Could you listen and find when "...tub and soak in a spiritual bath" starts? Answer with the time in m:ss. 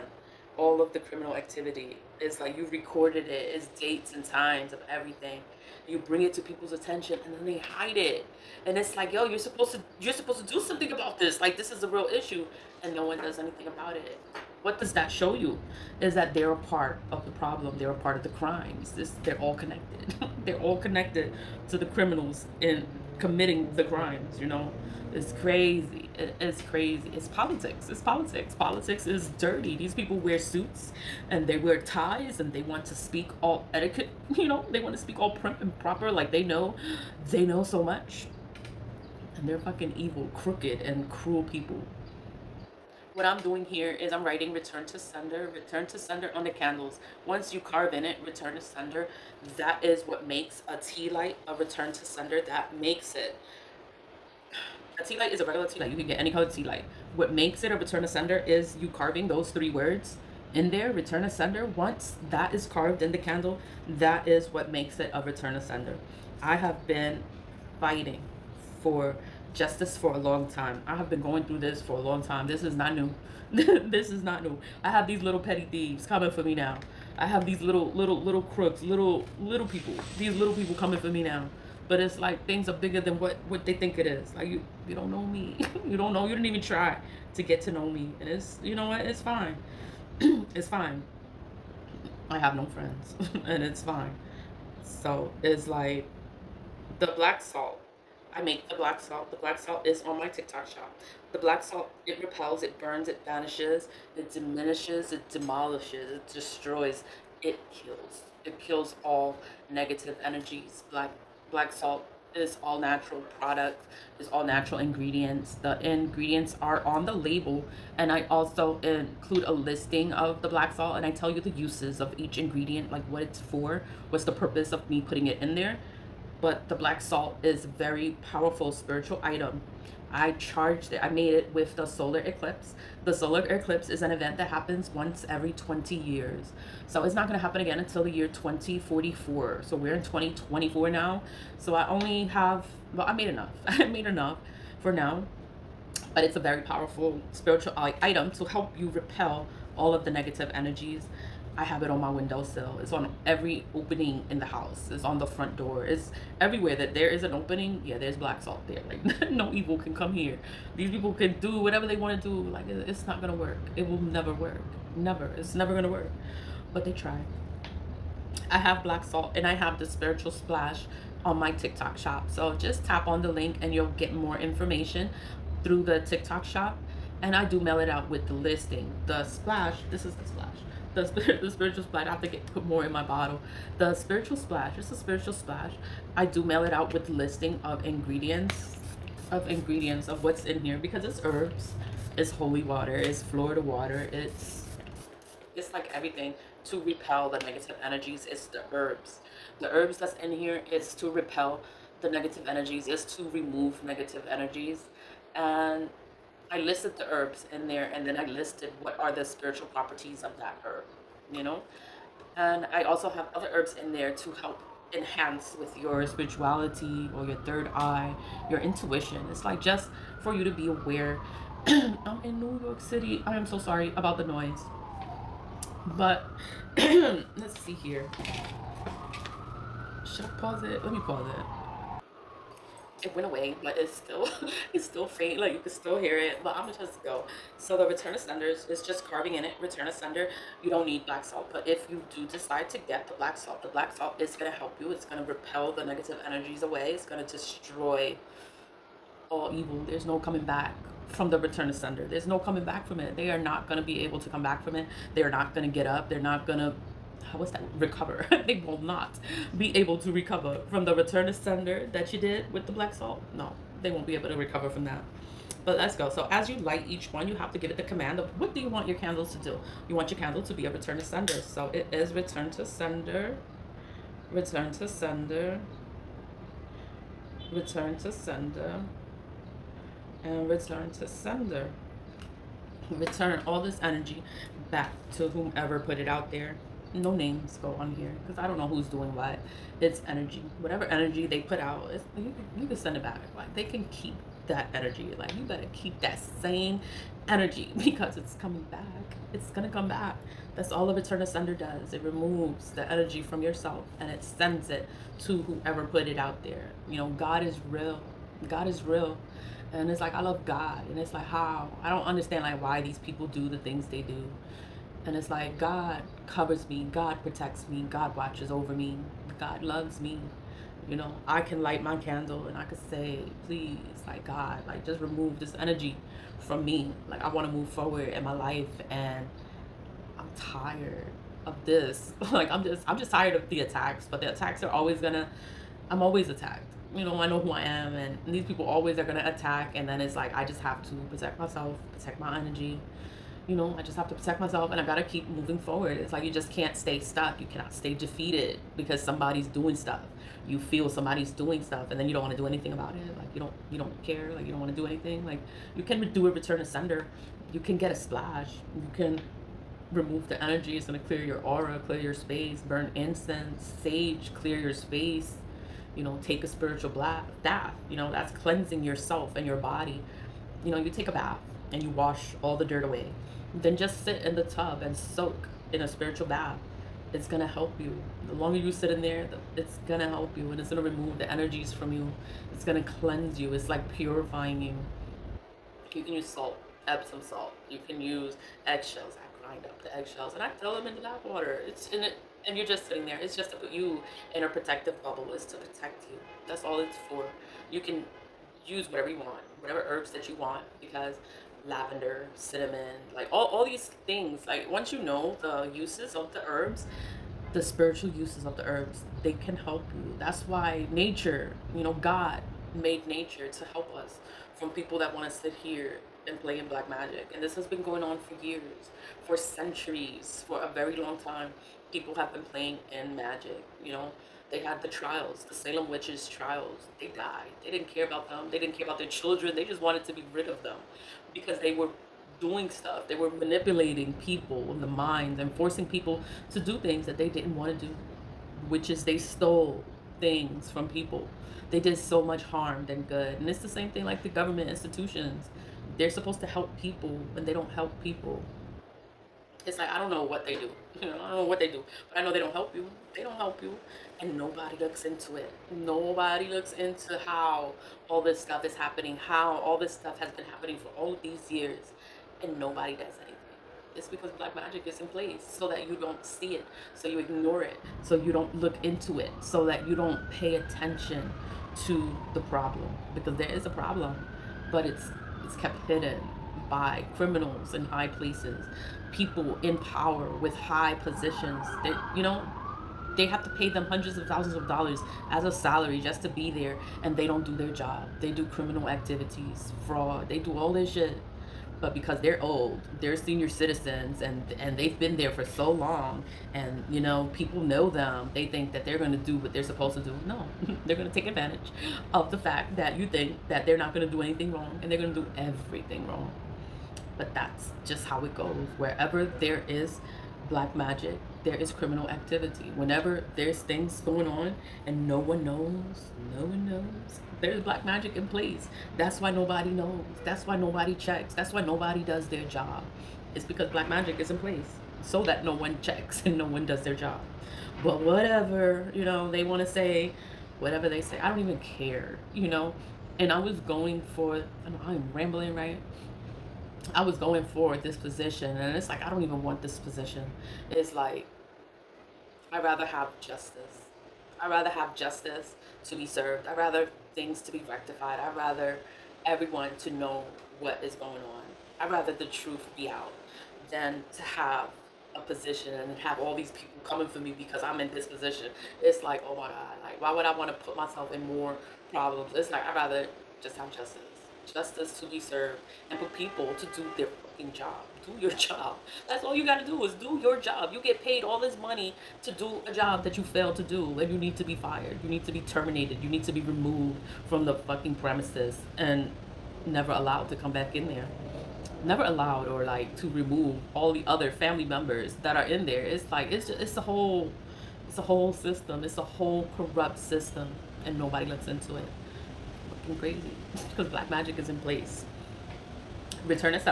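6:14.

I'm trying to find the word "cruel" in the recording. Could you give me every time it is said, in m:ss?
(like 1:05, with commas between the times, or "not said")
0:41.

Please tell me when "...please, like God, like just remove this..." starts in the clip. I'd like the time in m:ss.
5:23.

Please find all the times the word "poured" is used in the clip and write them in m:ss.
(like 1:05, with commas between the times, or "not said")
not said.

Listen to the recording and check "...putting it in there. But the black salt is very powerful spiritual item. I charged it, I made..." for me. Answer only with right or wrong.
right.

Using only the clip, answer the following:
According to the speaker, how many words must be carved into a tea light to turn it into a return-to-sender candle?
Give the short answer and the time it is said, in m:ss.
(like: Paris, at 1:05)
3, at 0:59.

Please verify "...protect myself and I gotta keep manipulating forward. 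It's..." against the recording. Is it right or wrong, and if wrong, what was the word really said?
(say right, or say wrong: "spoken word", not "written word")
wrong: "moving", not "manipulating".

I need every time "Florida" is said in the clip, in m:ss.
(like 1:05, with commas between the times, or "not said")
3:13.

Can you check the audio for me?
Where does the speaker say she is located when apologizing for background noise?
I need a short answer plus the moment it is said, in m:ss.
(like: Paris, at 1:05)
New York City, at 3:41.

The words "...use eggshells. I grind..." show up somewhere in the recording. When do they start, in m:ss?
6:28.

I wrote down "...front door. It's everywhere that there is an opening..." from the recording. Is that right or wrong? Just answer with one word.
right.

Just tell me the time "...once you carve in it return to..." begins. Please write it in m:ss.
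0:47.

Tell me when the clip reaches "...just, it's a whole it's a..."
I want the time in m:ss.
9:46.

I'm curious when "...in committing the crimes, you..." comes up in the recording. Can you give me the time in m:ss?
0:22.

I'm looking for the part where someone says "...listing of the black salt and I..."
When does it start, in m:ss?
1:59.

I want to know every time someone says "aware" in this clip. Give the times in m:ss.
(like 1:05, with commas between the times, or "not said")
3:40.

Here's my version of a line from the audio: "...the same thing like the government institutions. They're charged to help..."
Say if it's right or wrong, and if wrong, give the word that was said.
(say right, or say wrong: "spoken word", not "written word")
wrong: "supposed", not "charged".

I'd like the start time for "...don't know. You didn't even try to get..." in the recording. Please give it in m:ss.
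1:25.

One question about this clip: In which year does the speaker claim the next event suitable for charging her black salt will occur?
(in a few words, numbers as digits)
2044.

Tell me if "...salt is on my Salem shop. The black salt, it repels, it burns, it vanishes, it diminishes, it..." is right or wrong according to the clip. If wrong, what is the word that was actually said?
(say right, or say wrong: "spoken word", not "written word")
wrong: "TikTok", not "Salem".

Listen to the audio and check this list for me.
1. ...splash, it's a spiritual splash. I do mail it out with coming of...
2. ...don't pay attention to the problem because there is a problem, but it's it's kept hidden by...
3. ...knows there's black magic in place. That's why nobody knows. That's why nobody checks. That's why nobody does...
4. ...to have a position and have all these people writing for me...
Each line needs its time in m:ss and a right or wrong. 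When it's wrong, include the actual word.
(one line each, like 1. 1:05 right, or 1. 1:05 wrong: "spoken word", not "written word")
1. 3:04 wrong: "listing", not "coming"
2. 7:49 right
3. 8:36 right
4. 9:14 wrong: "coming", not "writing".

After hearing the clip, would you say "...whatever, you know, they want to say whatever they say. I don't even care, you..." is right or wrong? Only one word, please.
right.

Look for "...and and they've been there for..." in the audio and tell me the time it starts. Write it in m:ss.
8:14.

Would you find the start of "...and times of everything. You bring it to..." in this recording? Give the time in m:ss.
0:04.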